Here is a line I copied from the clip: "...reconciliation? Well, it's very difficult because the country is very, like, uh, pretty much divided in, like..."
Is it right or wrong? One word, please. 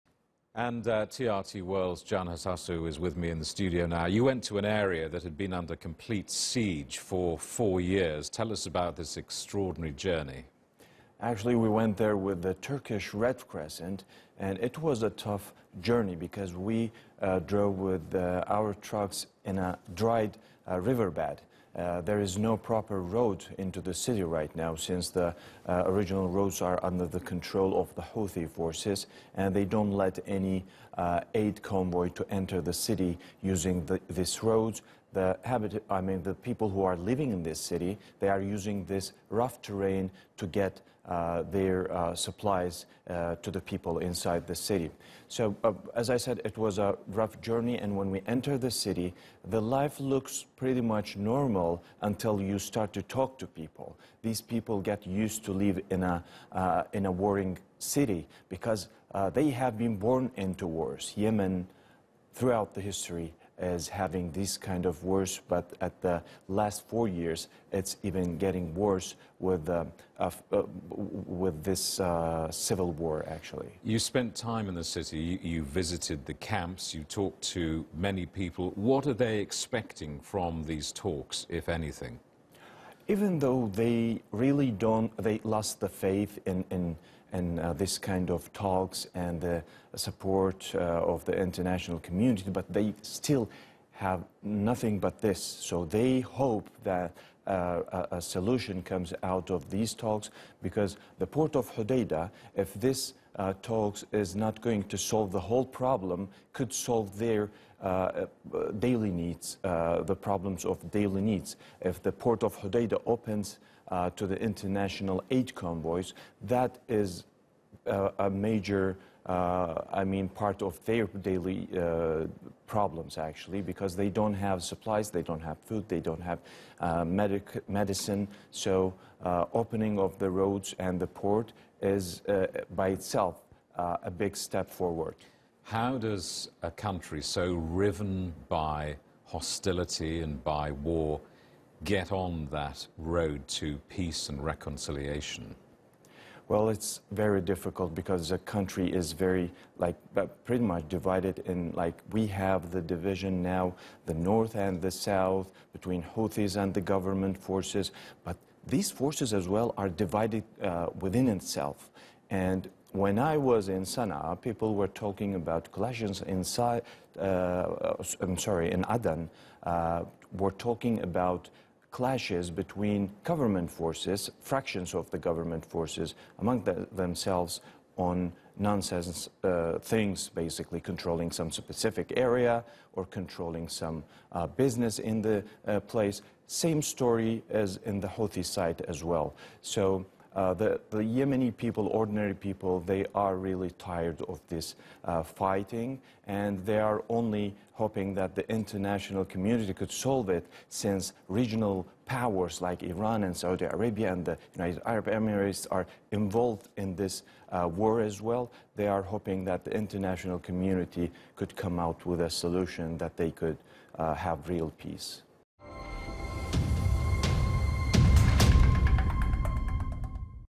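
right.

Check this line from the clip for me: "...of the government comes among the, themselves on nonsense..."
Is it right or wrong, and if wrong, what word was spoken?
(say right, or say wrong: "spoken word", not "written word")
wrong: "forces", not "comes".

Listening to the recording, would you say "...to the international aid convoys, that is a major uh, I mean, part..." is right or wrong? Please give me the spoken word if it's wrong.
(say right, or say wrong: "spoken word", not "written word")
right.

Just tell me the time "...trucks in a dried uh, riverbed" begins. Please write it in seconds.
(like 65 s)
18 s.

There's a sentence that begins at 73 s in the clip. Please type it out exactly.
You spent time in the city, you visited the camps, you talked to many people.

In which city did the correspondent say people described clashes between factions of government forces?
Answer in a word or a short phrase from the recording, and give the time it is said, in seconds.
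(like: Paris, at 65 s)
Aden, at 168 s.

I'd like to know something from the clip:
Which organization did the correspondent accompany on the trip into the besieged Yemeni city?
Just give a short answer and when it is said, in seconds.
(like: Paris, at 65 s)
Turkish Red Crescent, at 12 s.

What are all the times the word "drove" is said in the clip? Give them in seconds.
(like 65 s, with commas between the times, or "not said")
17 s.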